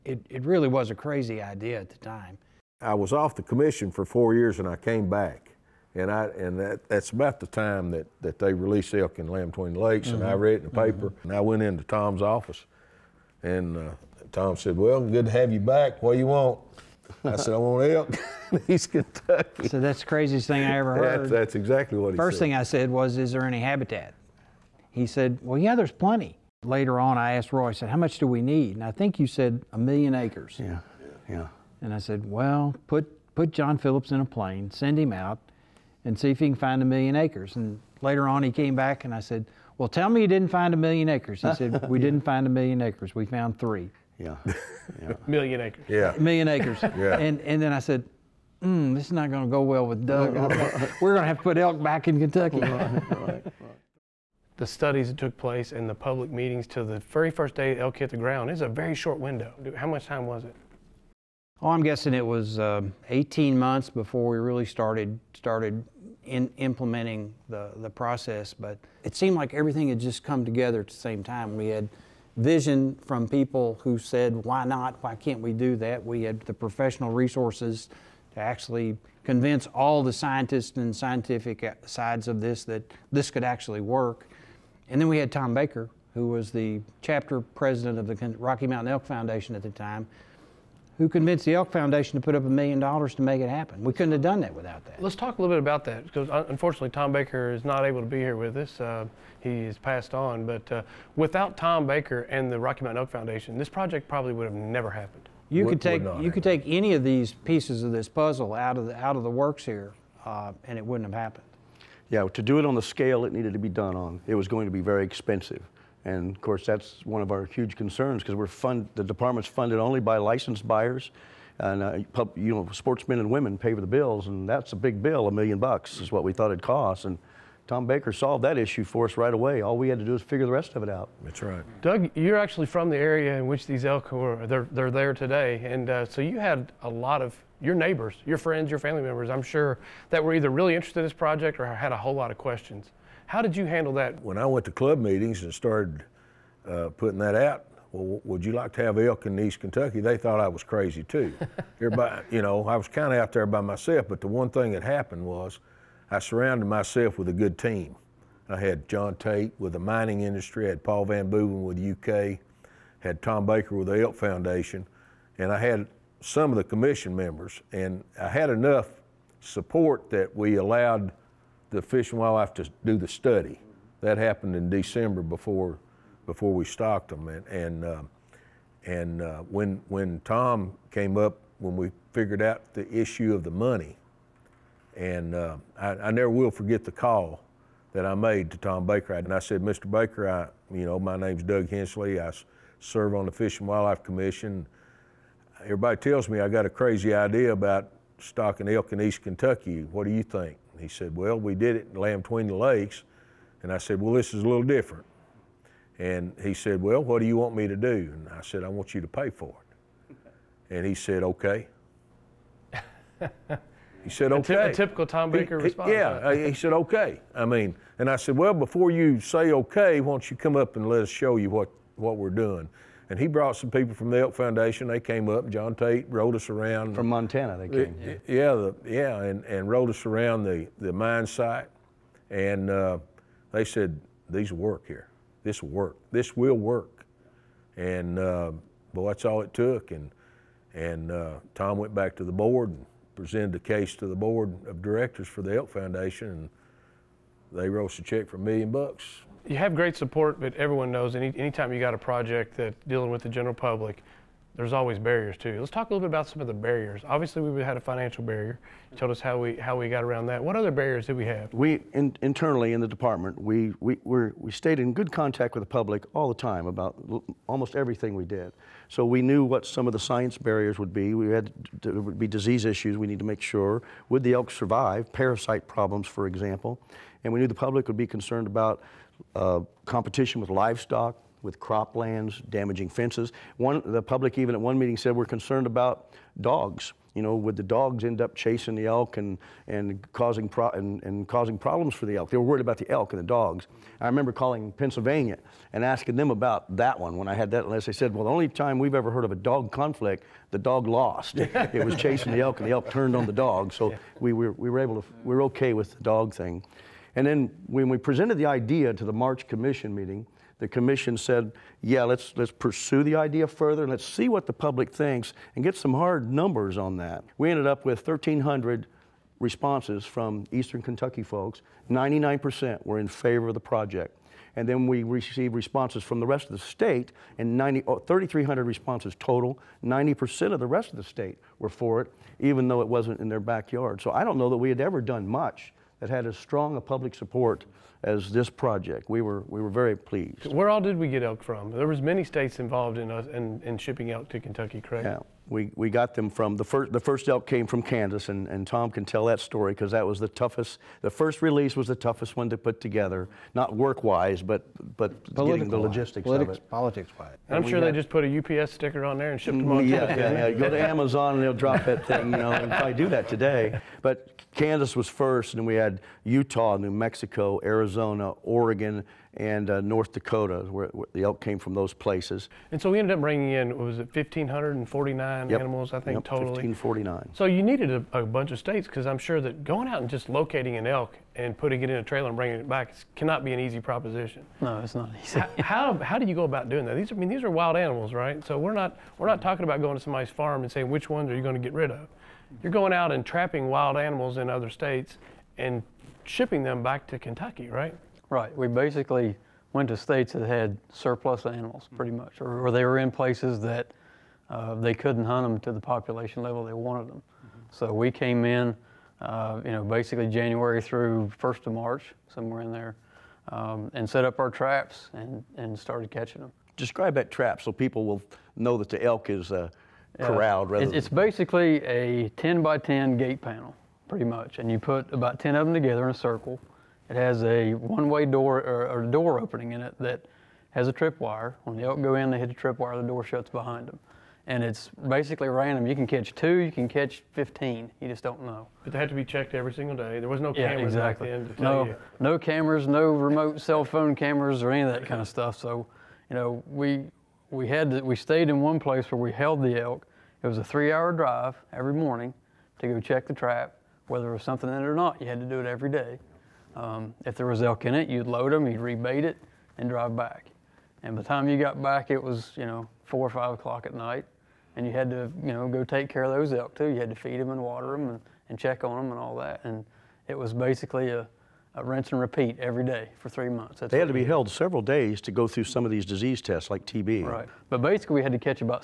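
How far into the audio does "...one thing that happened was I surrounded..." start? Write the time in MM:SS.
02:34.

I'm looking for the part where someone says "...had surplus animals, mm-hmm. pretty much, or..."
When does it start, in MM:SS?
06:40.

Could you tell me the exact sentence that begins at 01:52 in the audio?
Yeah, to do it on the scale it needed to be done on, it was going to be very expensive.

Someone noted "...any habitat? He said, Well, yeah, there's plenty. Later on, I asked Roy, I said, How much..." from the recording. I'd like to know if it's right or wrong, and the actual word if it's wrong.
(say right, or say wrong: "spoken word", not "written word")
right.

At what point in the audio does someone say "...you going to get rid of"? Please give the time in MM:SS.
06:31.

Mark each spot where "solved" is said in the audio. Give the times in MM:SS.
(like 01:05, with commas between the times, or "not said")
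02:08.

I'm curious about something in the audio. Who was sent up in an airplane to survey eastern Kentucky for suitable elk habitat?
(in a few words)
John Phillips.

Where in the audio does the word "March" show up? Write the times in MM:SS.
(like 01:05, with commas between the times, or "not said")
05:09, 06:51.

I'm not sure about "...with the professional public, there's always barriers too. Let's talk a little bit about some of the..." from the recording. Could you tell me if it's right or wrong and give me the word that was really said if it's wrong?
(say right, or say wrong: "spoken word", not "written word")
wrong: "general", not "professional".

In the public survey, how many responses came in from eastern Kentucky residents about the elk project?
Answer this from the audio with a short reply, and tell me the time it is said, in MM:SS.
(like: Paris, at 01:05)
1,300, at 05:18.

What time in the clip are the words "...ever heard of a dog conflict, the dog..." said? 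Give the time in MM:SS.
04:58.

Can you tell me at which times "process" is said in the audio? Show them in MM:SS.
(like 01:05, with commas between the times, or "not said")
01:07.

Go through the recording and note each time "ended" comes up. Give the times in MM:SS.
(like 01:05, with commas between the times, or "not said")
05:17, 06:12.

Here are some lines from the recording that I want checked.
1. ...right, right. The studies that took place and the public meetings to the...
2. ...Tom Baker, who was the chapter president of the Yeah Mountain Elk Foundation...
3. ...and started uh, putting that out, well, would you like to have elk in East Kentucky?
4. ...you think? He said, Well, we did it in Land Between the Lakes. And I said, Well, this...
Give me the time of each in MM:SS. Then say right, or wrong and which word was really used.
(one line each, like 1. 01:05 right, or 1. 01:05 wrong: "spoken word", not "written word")
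1. 00:52 right
2. 01:25 wrong: "Rocky", not "Yeah"
3. 02:25 right
4. 03:20 right.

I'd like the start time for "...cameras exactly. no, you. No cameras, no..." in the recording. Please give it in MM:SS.
07:20.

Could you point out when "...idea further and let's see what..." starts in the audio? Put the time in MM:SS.
05:13.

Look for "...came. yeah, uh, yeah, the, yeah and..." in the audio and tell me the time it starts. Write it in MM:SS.
03:47.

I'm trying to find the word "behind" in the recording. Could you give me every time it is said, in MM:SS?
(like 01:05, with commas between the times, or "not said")
07:13.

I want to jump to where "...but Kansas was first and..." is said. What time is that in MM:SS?
06:04.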